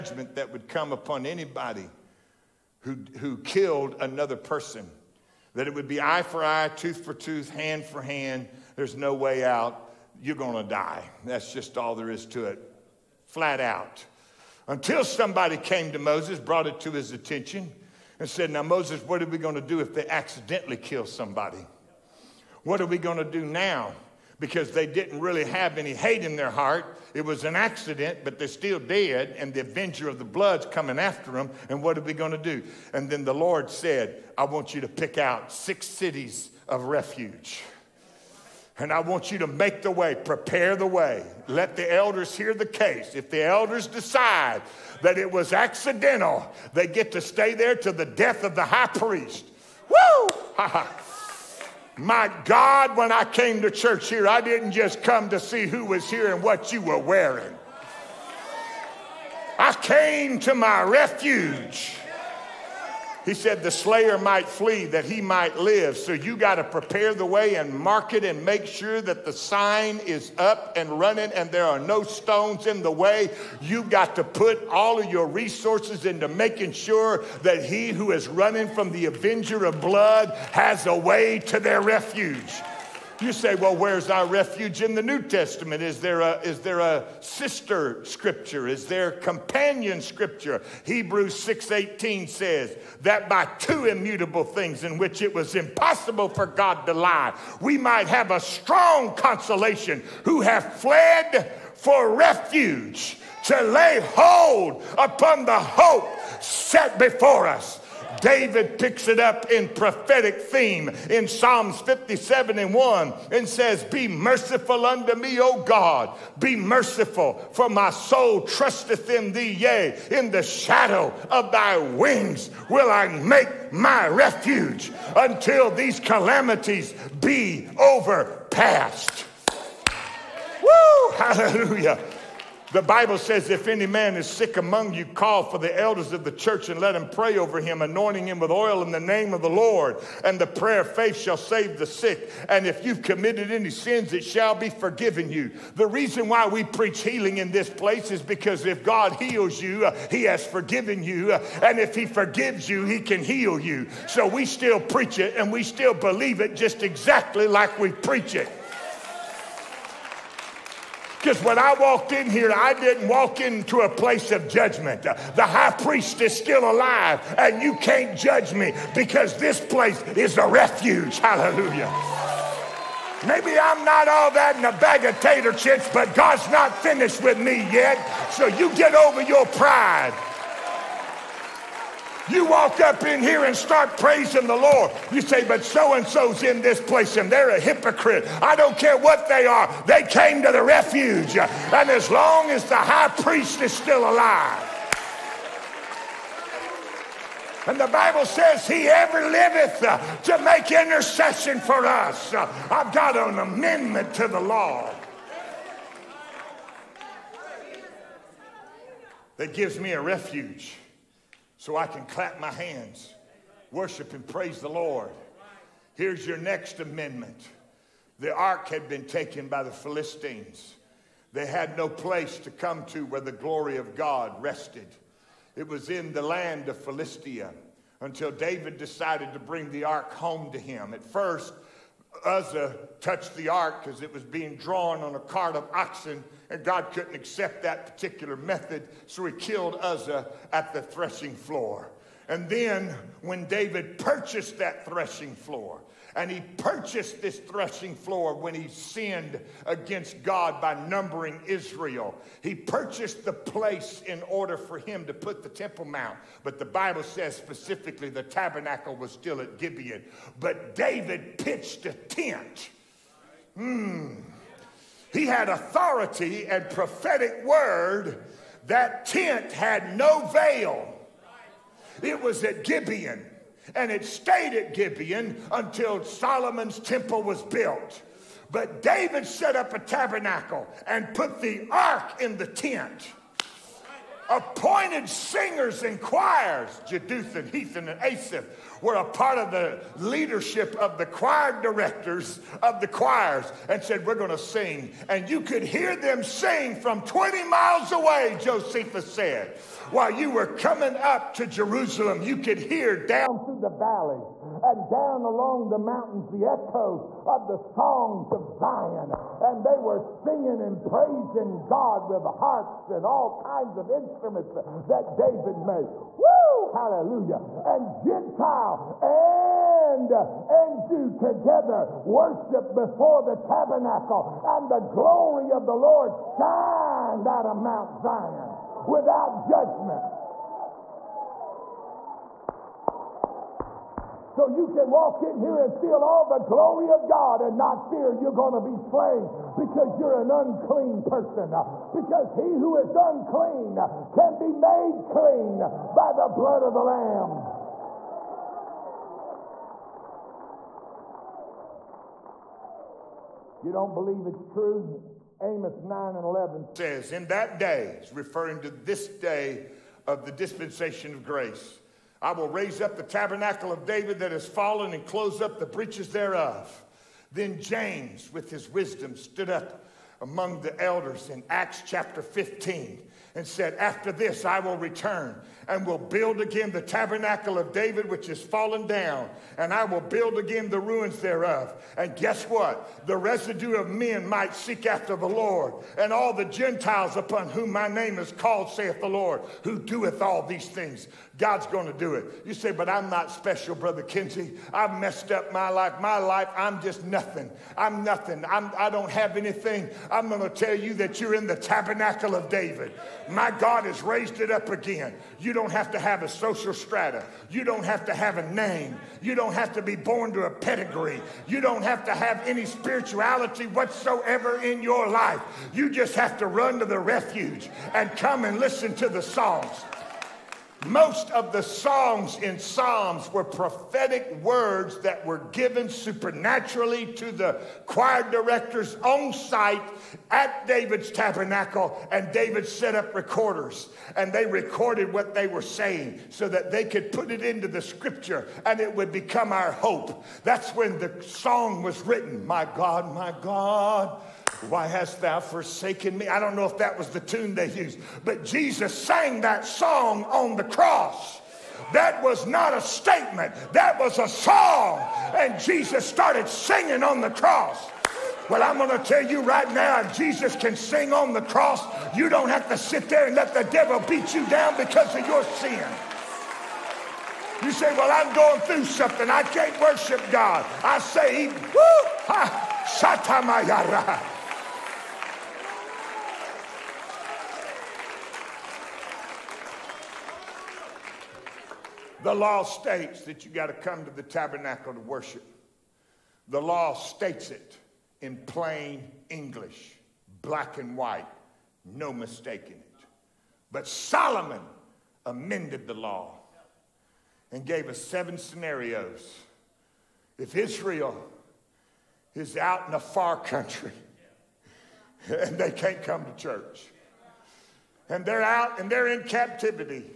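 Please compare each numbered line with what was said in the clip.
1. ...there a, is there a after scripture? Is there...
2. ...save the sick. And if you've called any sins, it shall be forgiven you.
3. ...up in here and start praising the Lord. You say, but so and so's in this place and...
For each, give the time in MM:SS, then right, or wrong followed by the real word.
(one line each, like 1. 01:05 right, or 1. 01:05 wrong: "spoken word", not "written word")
1. 01:26 wrong: "sister", not "after"
2. 02:21 wrong: "committed", not "called"
3. 03:02 right.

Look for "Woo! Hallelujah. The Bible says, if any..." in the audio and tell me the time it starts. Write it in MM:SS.
02:10.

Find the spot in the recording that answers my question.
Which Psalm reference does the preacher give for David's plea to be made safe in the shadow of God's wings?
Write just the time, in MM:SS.
01:51.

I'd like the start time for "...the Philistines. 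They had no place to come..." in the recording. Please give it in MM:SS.
03:39.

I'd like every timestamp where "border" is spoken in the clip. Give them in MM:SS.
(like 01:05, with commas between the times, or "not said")
not said.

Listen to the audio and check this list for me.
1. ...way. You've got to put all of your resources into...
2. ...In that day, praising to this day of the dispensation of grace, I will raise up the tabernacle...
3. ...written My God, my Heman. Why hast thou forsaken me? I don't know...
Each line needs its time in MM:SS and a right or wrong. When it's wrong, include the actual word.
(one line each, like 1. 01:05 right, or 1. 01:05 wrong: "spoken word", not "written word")
1. 01:12 right
2. 05:57 wrong: "referring", not "praising"
3. 07:22 wrong: "God", not "Heman".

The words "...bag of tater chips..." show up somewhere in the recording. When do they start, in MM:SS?
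02:54.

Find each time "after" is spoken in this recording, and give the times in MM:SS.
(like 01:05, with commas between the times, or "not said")
00:30, 06:13, 06:24.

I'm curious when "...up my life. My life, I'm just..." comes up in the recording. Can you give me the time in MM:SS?
06:35.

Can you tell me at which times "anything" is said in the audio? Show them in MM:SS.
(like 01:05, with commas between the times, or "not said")
06:39.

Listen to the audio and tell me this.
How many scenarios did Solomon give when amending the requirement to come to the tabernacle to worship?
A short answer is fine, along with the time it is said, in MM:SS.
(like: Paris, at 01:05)
7, at 08:18.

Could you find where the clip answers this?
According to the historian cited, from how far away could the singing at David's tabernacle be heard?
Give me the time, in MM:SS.
04:57.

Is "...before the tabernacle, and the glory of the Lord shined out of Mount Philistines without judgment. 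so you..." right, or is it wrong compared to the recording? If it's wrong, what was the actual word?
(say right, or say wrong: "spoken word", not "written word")
wrong: "Zion", not "Philistines".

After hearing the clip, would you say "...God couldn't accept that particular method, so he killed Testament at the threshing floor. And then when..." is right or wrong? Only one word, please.
wrong.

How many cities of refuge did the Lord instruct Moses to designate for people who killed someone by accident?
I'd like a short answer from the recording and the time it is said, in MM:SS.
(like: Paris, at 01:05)
6, at 00:35.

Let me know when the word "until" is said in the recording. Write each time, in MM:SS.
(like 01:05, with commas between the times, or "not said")
00:14, 02:05, 03:48, 04:35.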